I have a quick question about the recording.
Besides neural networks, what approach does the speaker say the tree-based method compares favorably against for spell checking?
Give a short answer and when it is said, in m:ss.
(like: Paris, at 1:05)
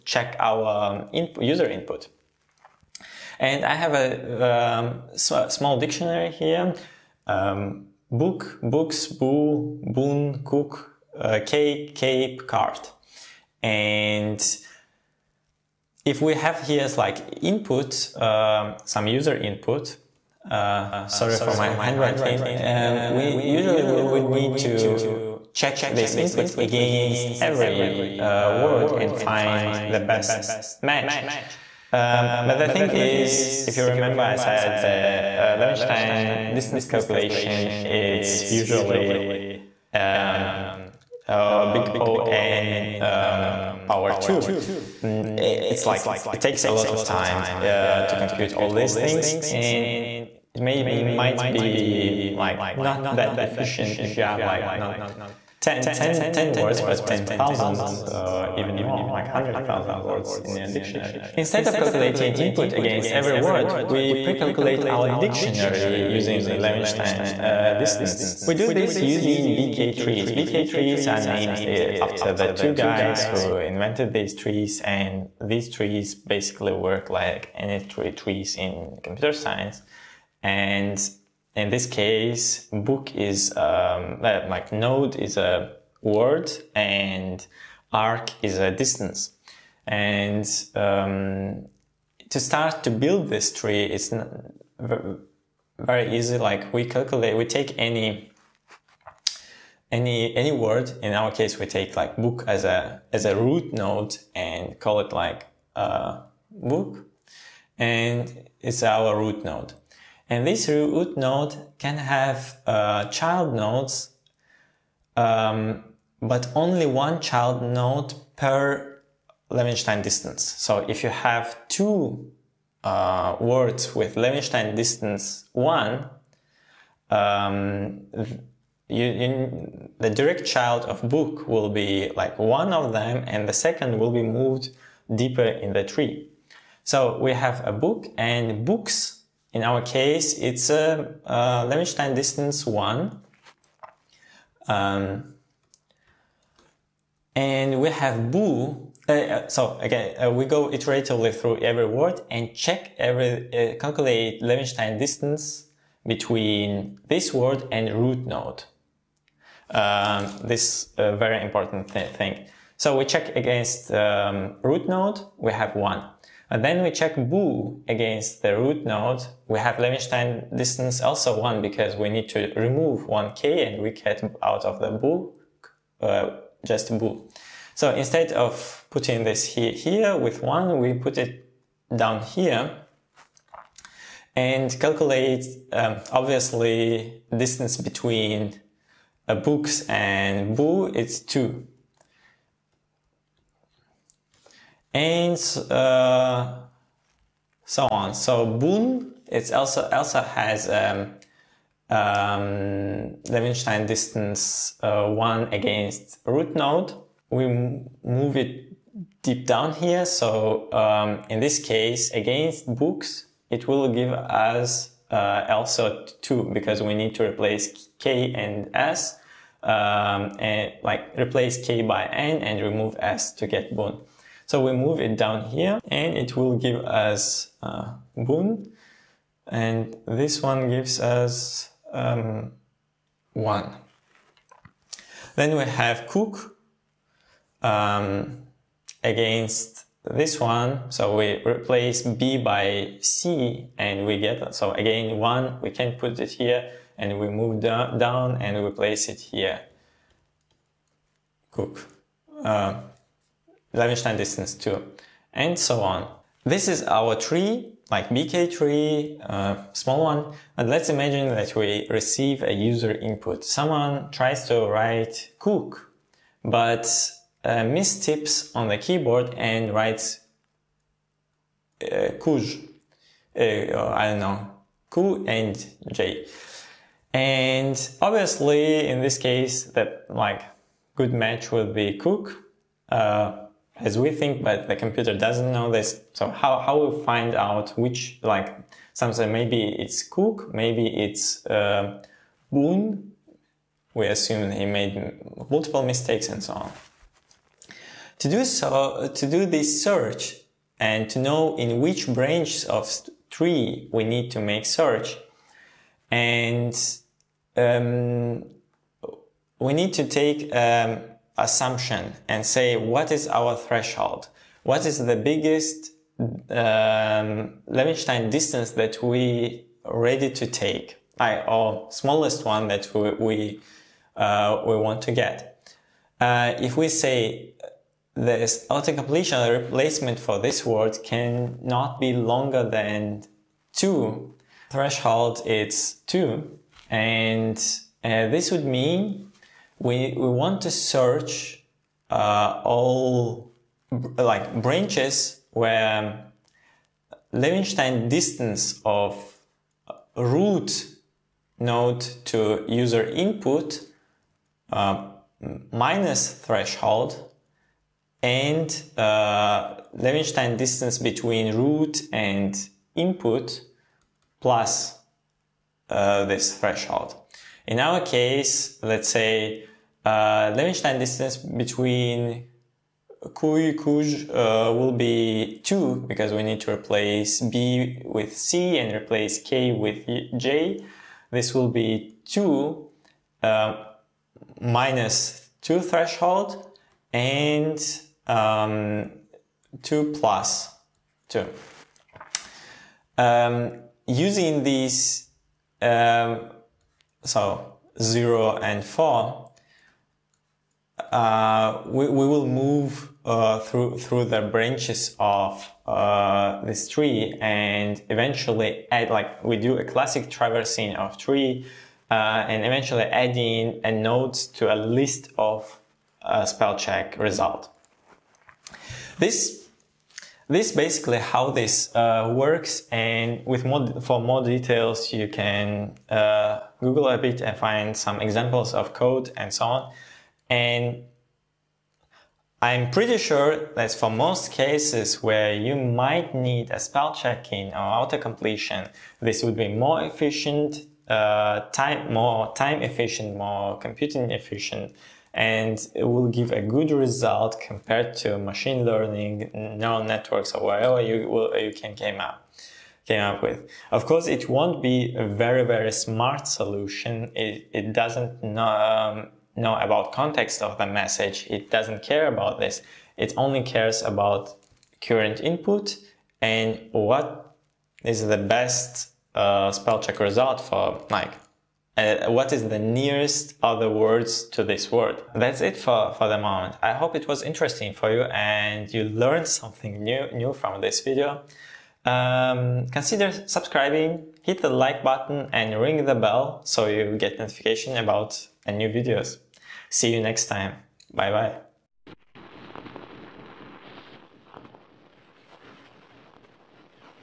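machine learning, at 7:28.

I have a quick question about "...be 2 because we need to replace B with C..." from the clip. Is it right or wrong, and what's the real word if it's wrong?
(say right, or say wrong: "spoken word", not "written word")
right.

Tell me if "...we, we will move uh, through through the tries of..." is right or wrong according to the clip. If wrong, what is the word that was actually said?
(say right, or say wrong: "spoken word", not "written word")
wrong: "branches", not "tries".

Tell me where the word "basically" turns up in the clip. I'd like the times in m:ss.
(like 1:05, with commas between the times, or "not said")
1:16, 7:00.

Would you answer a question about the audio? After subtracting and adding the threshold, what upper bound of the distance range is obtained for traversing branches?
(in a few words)
4.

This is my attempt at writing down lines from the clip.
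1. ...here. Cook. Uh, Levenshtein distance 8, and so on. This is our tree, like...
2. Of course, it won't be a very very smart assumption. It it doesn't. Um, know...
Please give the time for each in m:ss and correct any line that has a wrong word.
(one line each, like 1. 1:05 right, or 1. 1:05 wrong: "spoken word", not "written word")
1. 4:09 wrong: "2", not "8"
2. 7:33 wrong: "solution", not "assumption".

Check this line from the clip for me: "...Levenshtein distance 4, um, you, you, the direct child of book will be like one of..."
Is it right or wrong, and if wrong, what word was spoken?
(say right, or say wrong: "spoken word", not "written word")
wrong: "1", not "4".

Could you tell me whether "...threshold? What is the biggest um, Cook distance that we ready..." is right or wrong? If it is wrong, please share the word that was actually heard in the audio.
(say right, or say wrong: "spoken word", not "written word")
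wrong: "Levenshtein", not "Cook".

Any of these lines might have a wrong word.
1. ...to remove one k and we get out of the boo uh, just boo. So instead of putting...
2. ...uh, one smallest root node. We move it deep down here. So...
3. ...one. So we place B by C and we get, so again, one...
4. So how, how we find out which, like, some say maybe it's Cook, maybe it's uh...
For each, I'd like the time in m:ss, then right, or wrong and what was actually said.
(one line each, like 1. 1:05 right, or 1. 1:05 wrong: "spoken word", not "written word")
1. 2:52 right
2. 3:24 wrong: "against", not "smallest"
3. 4:00 wrong: "replace", not "place"
4. 4:46 right.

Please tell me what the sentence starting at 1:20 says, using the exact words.
And in this case, book is um, like node is a word and arc is a distance.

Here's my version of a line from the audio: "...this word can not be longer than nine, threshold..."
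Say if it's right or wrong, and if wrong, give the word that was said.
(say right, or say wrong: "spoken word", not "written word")
wrong: "two", not "nine".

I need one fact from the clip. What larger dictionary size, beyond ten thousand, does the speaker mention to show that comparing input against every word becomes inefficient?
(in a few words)
100,000 words.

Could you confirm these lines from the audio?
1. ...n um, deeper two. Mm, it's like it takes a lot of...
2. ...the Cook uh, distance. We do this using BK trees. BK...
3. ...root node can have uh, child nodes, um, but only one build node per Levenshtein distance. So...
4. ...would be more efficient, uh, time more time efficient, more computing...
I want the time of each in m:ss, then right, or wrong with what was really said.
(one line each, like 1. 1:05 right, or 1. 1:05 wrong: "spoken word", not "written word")
1. 0:42 wrong: "power", not "deeper"
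2. 1:06 wrong: "Levenshtein", not "Cook"
3. 1:50 wrong: "child", not "build"
4. 7:19 right.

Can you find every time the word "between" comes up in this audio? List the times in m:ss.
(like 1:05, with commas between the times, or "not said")
2:36, 3:07, 6:00, 6:11.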